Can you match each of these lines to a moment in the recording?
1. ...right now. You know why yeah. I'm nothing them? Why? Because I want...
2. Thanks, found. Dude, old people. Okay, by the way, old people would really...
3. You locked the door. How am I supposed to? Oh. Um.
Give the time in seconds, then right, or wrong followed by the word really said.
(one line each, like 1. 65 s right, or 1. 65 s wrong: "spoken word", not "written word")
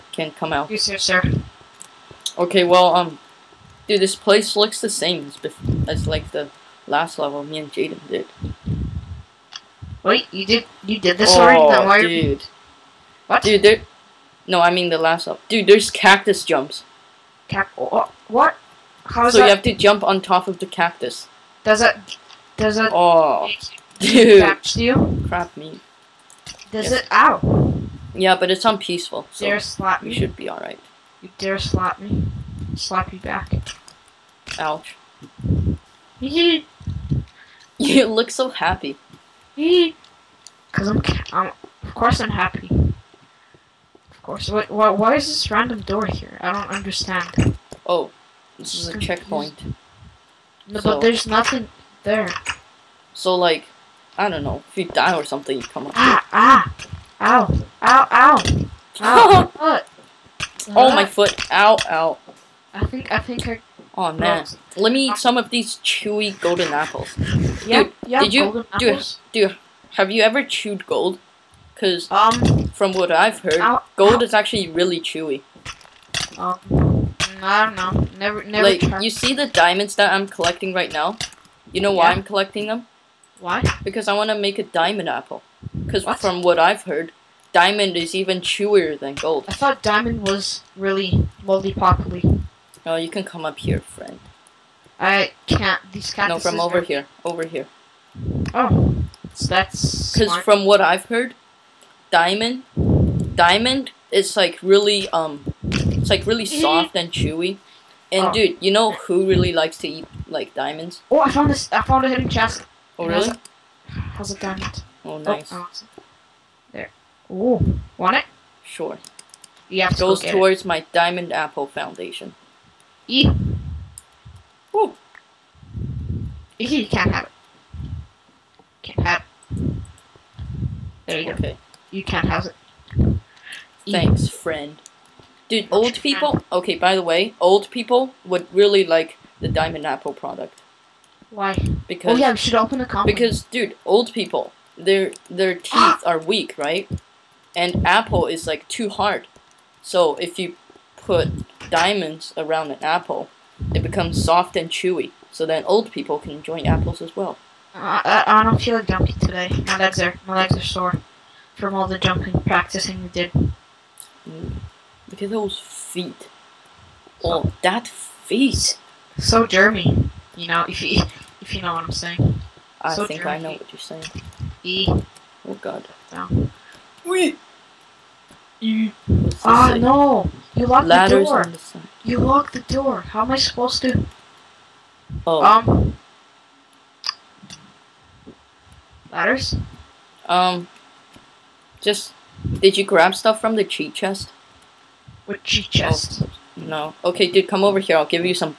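1. 80 s wrong: "collecting", not "nothing"
2. 133 s wrong: "friend", not "found"
3. 182 s right.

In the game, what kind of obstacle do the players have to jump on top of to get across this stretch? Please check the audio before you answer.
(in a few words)
Cactus jumps.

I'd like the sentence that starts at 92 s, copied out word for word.
No, you can come up here, friend.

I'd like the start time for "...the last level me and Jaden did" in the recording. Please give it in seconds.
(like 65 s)
6 s.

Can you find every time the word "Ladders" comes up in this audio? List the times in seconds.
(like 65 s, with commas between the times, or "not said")
180 s, 189 s.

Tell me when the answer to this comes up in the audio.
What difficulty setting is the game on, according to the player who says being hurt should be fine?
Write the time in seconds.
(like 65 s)
28 s.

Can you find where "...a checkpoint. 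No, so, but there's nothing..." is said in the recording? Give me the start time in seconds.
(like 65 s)
48 s.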